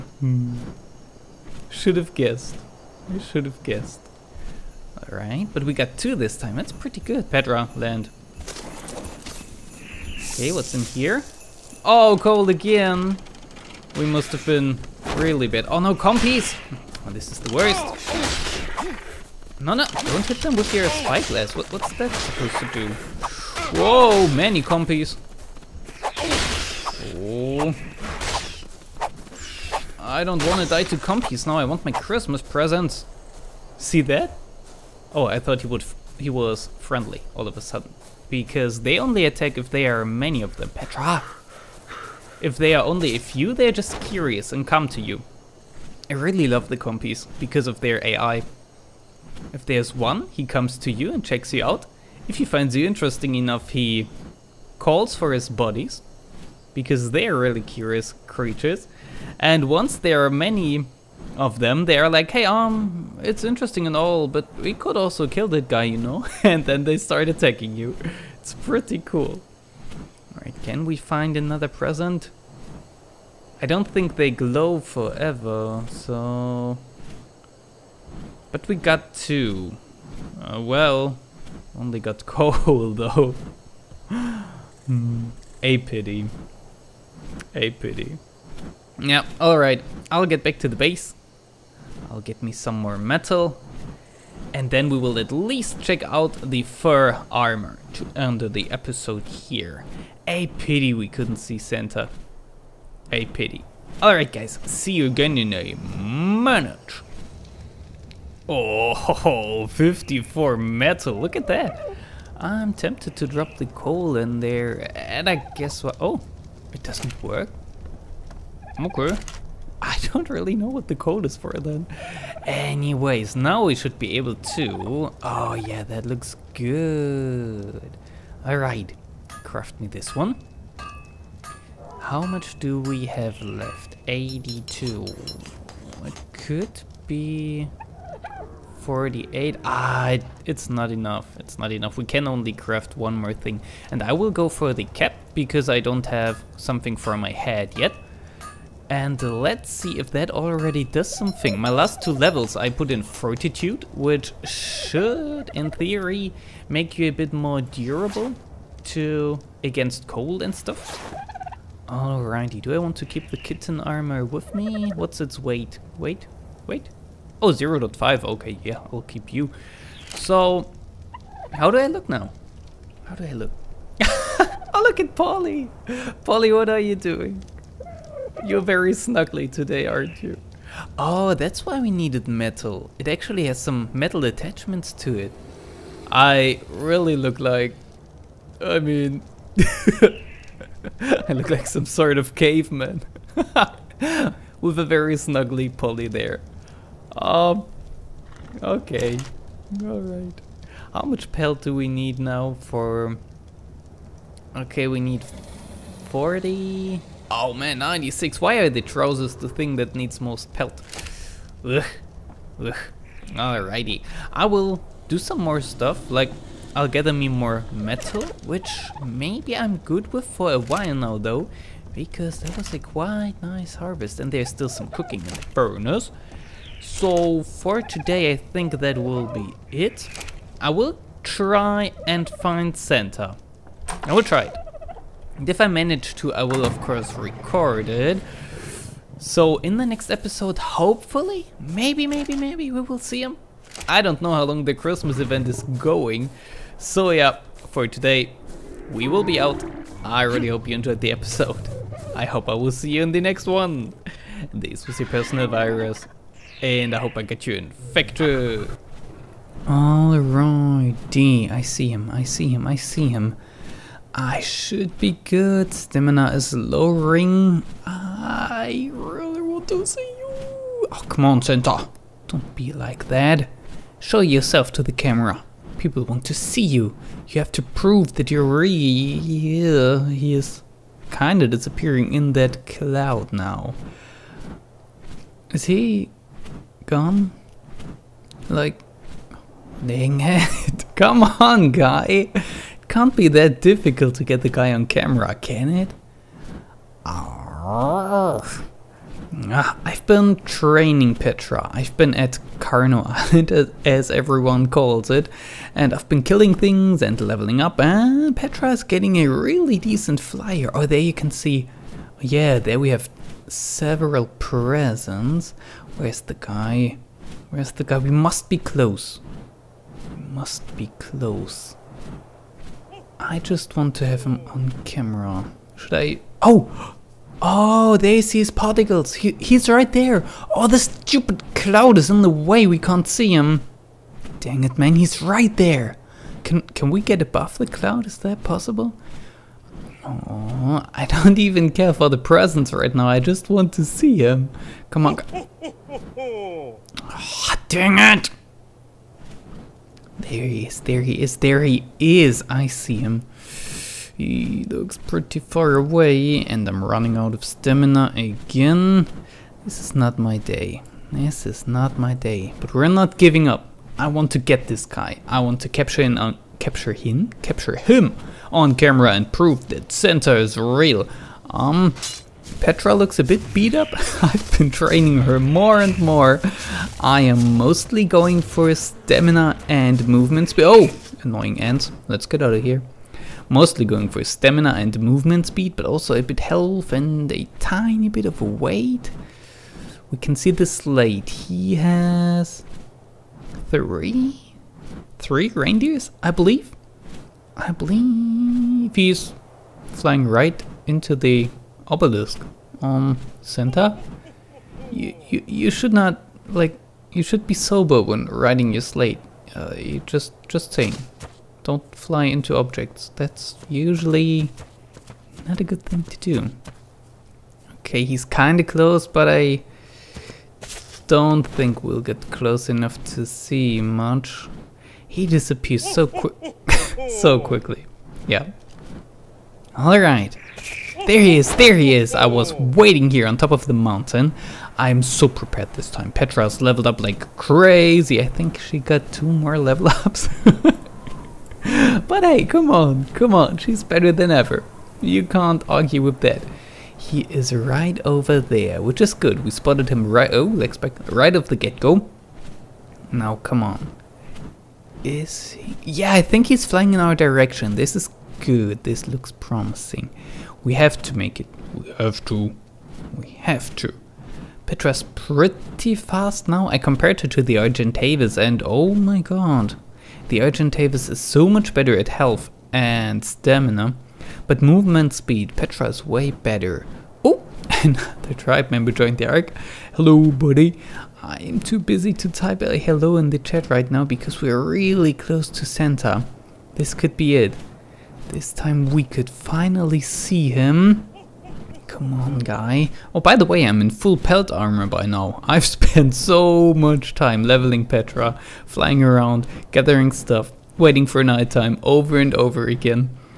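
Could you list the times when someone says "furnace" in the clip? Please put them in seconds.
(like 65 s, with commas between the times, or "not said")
225 s.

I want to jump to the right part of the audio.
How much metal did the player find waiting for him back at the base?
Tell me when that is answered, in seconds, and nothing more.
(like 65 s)
109 s.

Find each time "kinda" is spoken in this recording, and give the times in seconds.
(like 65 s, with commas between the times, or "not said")
281 s, 418 s.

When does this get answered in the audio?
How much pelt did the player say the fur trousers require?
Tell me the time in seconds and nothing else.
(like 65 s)
207 s.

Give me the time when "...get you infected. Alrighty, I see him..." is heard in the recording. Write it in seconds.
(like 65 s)
257 s.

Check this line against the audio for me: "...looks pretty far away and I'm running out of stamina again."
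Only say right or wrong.
right.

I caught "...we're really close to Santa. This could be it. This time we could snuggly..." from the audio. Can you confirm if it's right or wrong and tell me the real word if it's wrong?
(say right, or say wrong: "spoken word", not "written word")
wrong: "finally", not "snuggly".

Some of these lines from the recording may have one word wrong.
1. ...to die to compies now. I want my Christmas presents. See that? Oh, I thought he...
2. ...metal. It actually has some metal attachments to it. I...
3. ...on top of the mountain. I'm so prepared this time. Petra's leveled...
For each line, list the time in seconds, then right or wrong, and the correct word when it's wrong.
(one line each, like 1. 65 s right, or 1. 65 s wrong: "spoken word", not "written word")
1. 30 s right
2. 182 s right
3. 433 s right.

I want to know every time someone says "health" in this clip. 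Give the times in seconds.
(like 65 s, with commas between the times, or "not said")
386 s, 472 s.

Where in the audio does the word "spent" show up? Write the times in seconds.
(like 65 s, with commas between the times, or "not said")
495 s.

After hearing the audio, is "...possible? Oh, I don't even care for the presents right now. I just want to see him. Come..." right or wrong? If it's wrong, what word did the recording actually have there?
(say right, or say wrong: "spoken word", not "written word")
right.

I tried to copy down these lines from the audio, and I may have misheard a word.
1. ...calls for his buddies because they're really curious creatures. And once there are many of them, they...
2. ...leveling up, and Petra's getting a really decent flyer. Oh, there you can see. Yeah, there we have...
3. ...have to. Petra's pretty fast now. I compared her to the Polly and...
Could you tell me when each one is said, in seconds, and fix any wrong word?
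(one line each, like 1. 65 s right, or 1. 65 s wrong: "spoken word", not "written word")
1. 54 s right
2. 307 s right
3. 463 s wrong: "Argentavis", not "Polly".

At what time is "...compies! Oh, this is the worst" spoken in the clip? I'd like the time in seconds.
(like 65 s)
15 s.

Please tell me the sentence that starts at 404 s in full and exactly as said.
You, you, you should not, like, you should be sober when riding your slate.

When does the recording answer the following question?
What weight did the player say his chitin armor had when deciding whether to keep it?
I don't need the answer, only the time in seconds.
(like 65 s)
167 s.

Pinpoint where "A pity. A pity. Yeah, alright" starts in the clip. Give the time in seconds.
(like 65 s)
85 s.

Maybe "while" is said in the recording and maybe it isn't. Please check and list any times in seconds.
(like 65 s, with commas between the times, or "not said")
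220 s.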